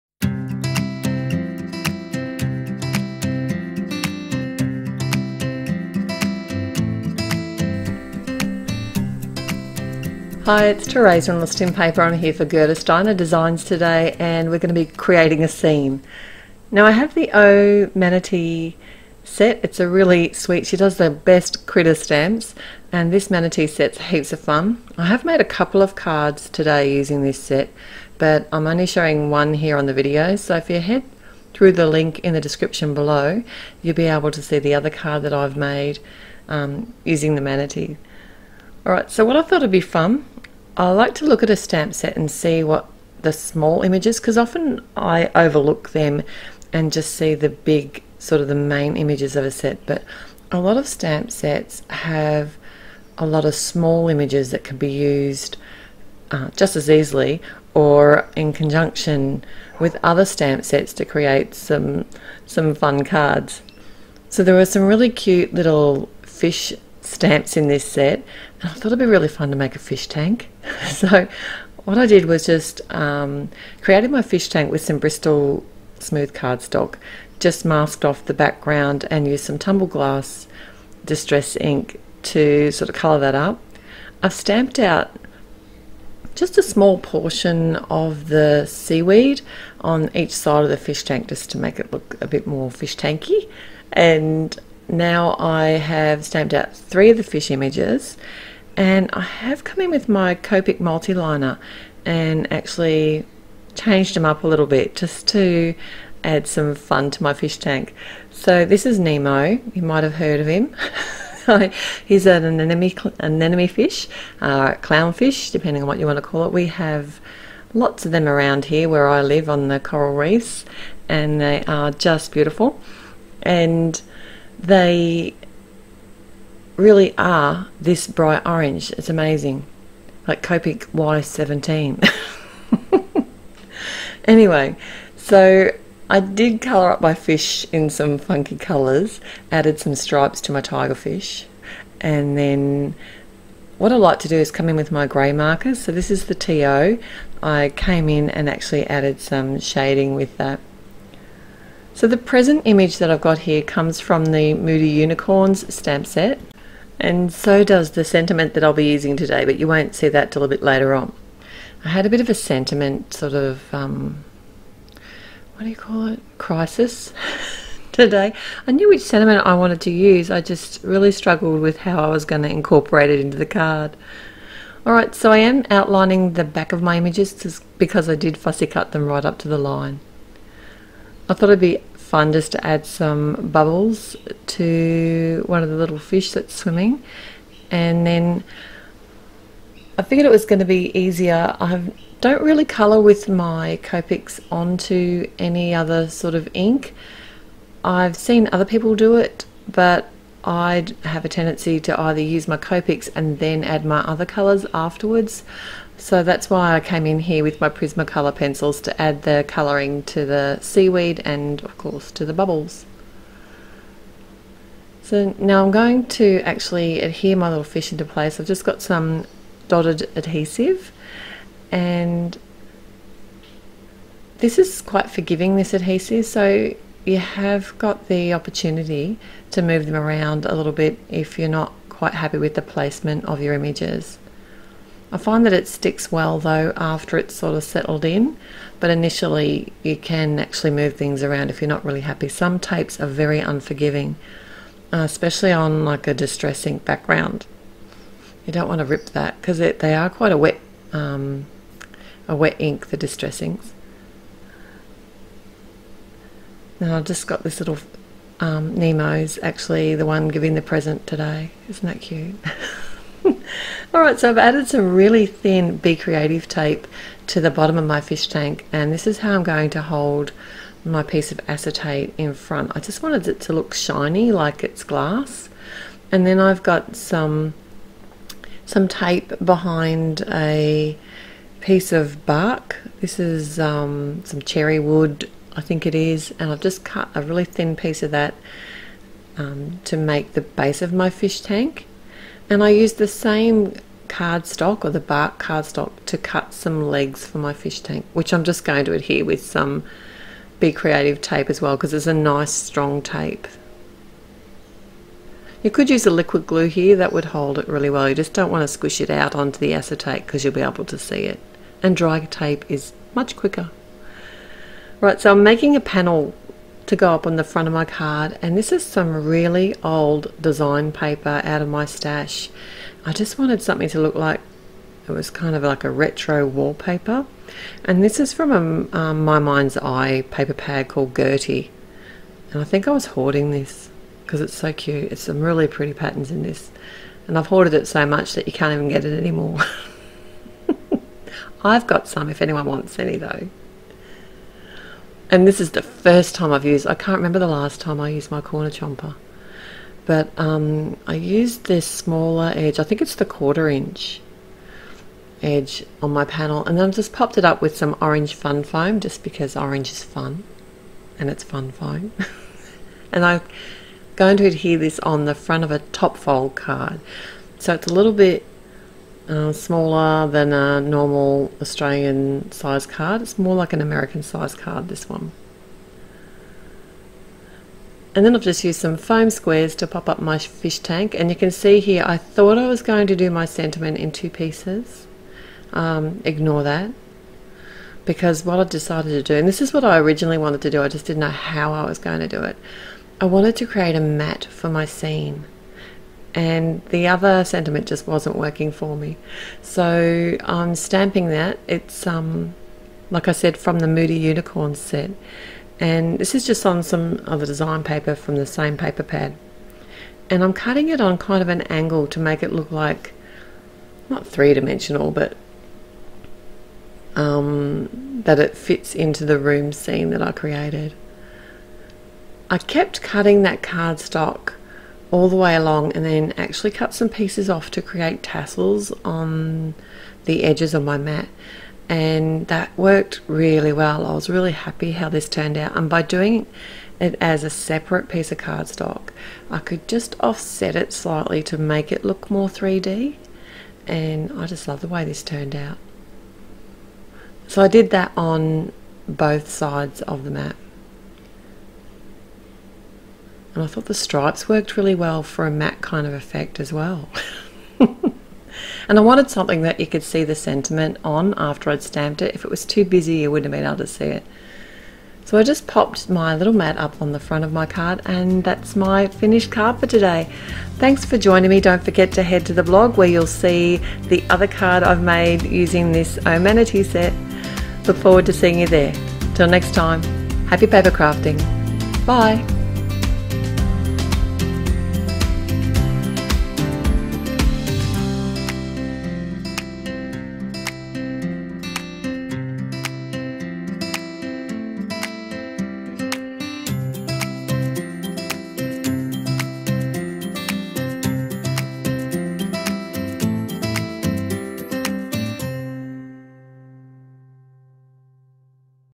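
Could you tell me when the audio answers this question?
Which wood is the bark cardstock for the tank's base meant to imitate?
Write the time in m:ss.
4:44.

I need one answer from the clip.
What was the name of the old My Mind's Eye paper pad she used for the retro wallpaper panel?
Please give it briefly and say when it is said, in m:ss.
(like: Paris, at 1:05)
Gertie, at 5:31.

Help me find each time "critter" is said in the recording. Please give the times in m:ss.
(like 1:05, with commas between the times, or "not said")
0:21.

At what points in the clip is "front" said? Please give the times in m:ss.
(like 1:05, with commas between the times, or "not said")
4:32, 5:17, 6:05, 7:47.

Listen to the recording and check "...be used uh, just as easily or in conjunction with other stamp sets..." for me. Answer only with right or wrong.
right.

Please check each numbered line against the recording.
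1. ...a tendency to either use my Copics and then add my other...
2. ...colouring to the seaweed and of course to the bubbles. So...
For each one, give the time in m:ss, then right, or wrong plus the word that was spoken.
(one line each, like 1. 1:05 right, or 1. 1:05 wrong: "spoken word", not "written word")
1. 3:21 right
2. 3:29 right.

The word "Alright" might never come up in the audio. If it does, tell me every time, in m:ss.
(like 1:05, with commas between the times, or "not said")
0:38, 2:54, 4:23.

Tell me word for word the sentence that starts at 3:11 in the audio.
I don't really colour with my Copics onto any other sort of ink.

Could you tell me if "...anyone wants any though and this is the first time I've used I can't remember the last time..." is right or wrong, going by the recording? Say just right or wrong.
right.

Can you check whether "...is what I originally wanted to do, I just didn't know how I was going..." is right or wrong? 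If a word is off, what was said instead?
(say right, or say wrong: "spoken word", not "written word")
right.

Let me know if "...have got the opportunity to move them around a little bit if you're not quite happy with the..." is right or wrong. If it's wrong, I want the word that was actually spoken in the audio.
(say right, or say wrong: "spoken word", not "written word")
right.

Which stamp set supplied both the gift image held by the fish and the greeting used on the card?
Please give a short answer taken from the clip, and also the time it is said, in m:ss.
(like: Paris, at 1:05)
Moody Unicorns, at 2:34.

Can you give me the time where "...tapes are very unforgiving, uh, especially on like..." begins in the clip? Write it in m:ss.
4:02.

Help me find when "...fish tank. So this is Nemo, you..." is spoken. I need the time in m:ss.
1:47.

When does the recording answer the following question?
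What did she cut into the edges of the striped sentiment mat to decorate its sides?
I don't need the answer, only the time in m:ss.
7:08.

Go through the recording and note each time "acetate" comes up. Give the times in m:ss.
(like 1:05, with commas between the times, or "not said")
4:31, 5:09.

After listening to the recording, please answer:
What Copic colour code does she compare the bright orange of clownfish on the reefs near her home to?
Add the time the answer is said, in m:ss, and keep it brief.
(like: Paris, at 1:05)
Y17, at 2:10.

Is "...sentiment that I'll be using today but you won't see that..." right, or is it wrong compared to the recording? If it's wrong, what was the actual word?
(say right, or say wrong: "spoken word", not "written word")
right.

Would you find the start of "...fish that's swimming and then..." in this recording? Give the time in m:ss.
3:05.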